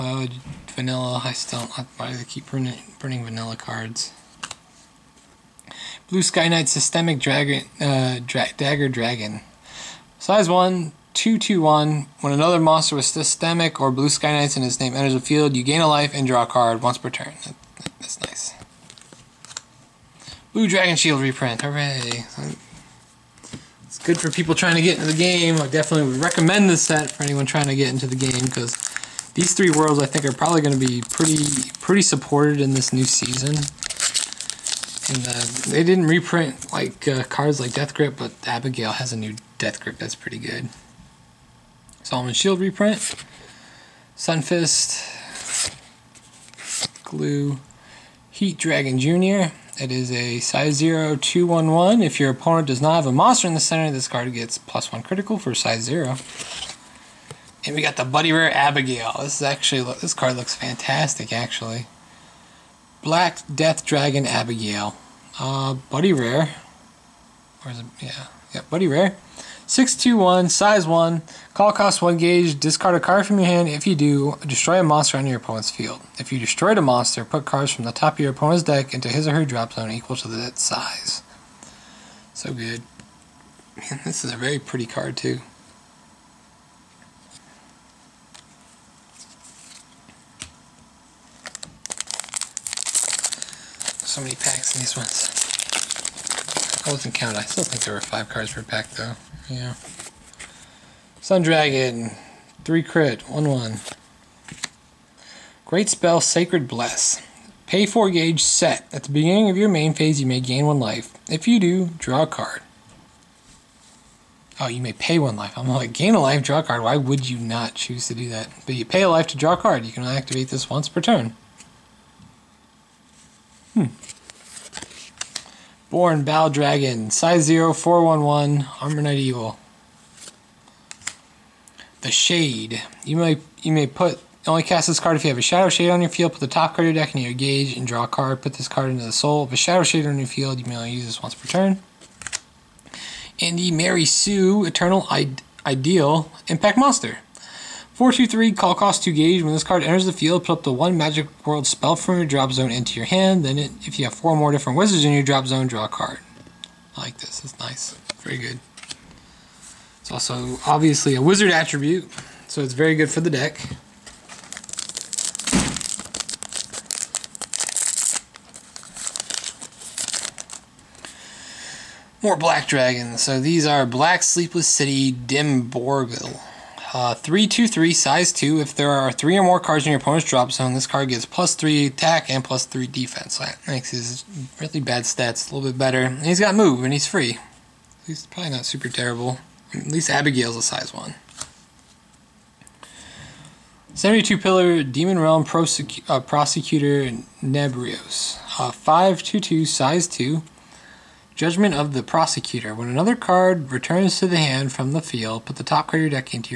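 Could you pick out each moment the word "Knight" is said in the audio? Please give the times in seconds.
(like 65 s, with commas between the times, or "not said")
6 s, 14 s, 129 s.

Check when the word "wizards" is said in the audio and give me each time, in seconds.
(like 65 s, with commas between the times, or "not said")
154 s, 161 s.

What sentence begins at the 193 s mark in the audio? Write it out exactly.
72 Pillar Demon Realm Prosecu- uh, Prosecutor Nebrios.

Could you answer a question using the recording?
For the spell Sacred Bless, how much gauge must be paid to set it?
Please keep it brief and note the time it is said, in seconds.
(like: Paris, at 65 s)
4 gauge, at 107 s.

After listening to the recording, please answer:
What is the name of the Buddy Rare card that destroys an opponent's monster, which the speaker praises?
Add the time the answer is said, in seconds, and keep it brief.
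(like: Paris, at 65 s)
Black Death Dragon Abigail, at 63 s.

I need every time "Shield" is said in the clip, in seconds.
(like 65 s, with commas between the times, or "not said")
20 s, 42 s.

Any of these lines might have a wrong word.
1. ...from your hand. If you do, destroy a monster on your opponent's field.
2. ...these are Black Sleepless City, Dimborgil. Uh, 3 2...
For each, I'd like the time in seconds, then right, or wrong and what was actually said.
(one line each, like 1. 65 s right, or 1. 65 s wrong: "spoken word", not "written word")
1. 73 s right
2. 173 s right.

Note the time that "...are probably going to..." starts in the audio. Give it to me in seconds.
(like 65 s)
30 s.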